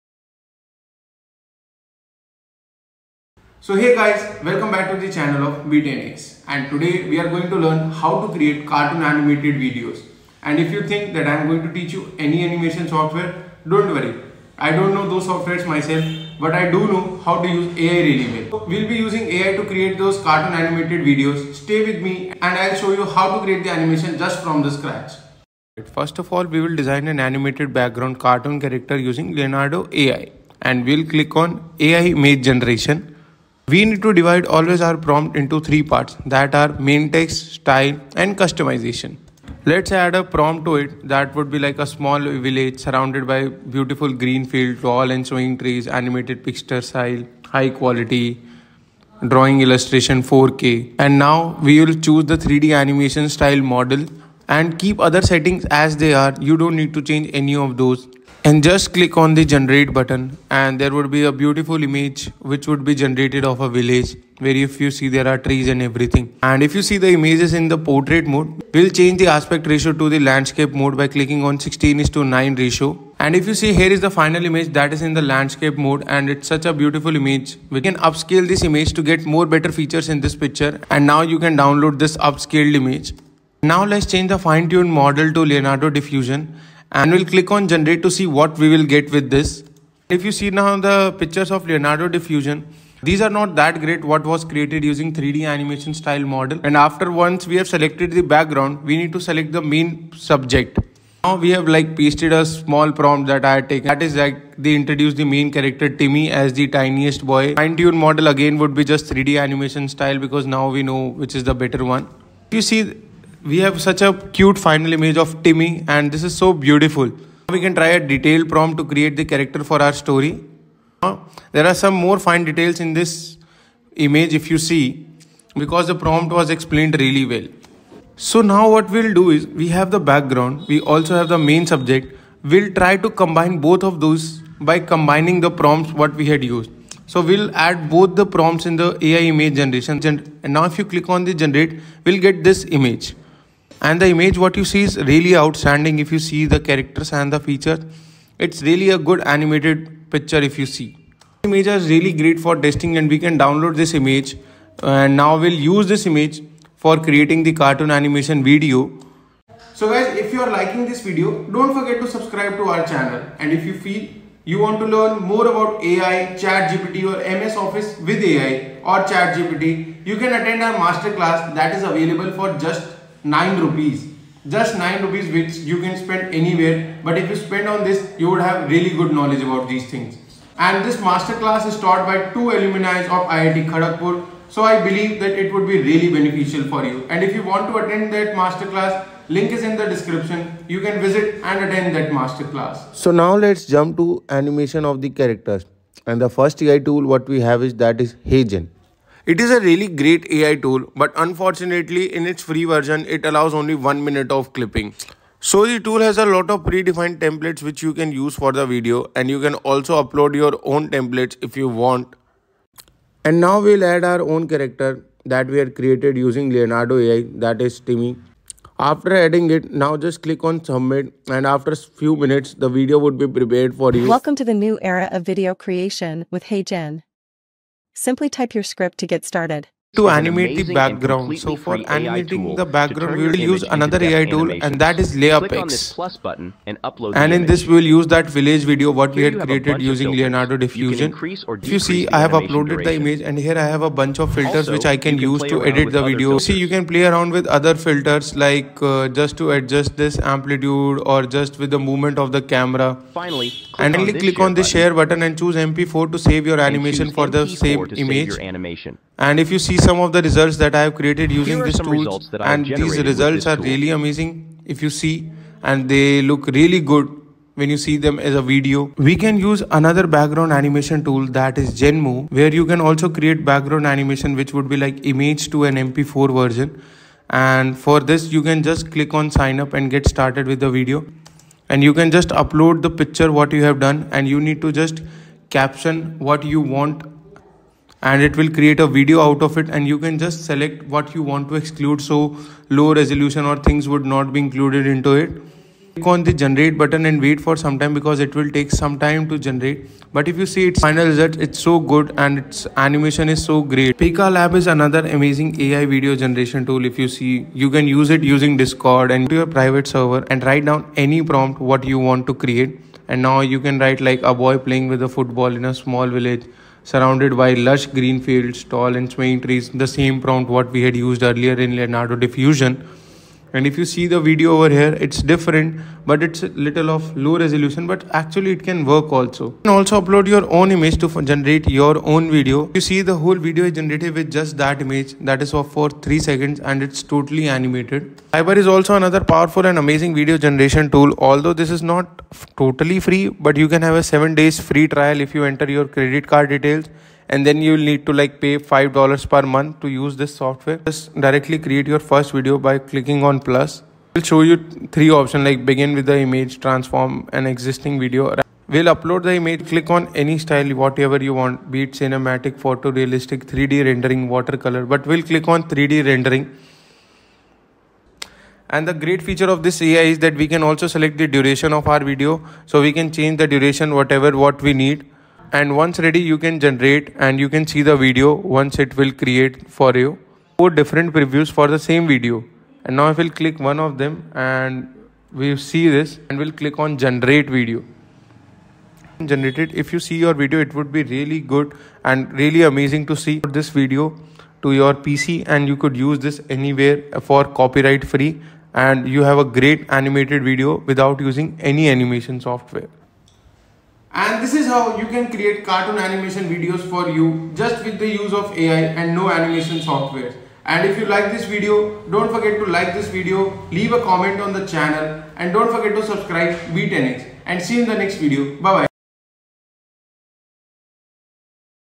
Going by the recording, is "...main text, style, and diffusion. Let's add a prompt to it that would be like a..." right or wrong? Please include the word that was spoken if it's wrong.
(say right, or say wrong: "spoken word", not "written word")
wrong: "customization", not "diffusion".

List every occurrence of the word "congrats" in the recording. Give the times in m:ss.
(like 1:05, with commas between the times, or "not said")
not said.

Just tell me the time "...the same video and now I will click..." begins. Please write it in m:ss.
6:21.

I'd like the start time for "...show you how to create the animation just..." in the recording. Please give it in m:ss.
0:22.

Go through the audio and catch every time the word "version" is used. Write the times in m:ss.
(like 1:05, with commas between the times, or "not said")
3:22, 4:36.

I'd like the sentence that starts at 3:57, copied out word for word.
and in this, we will use that village video what we had created using Leonardo Diffusion.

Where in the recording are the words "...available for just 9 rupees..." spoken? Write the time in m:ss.
2:51.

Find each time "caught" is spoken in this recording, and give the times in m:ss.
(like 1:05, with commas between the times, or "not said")
not said.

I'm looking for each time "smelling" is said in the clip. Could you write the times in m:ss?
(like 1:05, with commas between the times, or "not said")
not said.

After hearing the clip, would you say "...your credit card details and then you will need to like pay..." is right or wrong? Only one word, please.
right.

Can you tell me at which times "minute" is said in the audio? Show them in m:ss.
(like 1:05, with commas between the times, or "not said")
3:24, 3:42.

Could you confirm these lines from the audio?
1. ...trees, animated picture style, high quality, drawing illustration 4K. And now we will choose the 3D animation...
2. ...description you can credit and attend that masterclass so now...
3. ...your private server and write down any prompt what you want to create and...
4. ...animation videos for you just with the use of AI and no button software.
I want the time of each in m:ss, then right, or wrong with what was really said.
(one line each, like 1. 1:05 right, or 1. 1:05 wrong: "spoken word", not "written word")
1. 0:45 right
2. 3:09 wrong: "visit", not "credit"
3. 5:09 right
4. 6:45 wrong: "animation", not "button".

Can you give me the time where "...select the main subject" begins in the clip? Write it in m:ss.
1:39.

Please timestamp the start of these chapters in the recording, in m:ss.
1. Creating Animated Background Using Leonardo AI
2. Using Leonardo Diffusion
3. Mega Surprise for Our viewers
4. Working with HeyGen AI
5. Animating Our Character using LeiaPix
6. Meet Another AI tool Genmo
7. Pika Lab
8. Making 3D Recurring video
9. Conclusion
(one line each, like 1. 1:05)
1. 0:25
2. 1:20
3. 2:40
4. 3:10
5. 3:51
6. 4:25
7. 5:00
8. 6:00
9. 6:40.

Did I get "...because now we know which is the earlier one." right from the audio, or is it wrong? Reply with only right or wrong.
wrong.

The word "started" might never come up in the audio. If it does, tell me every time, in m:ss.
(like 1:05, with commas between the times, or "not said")
3:49, 4:40.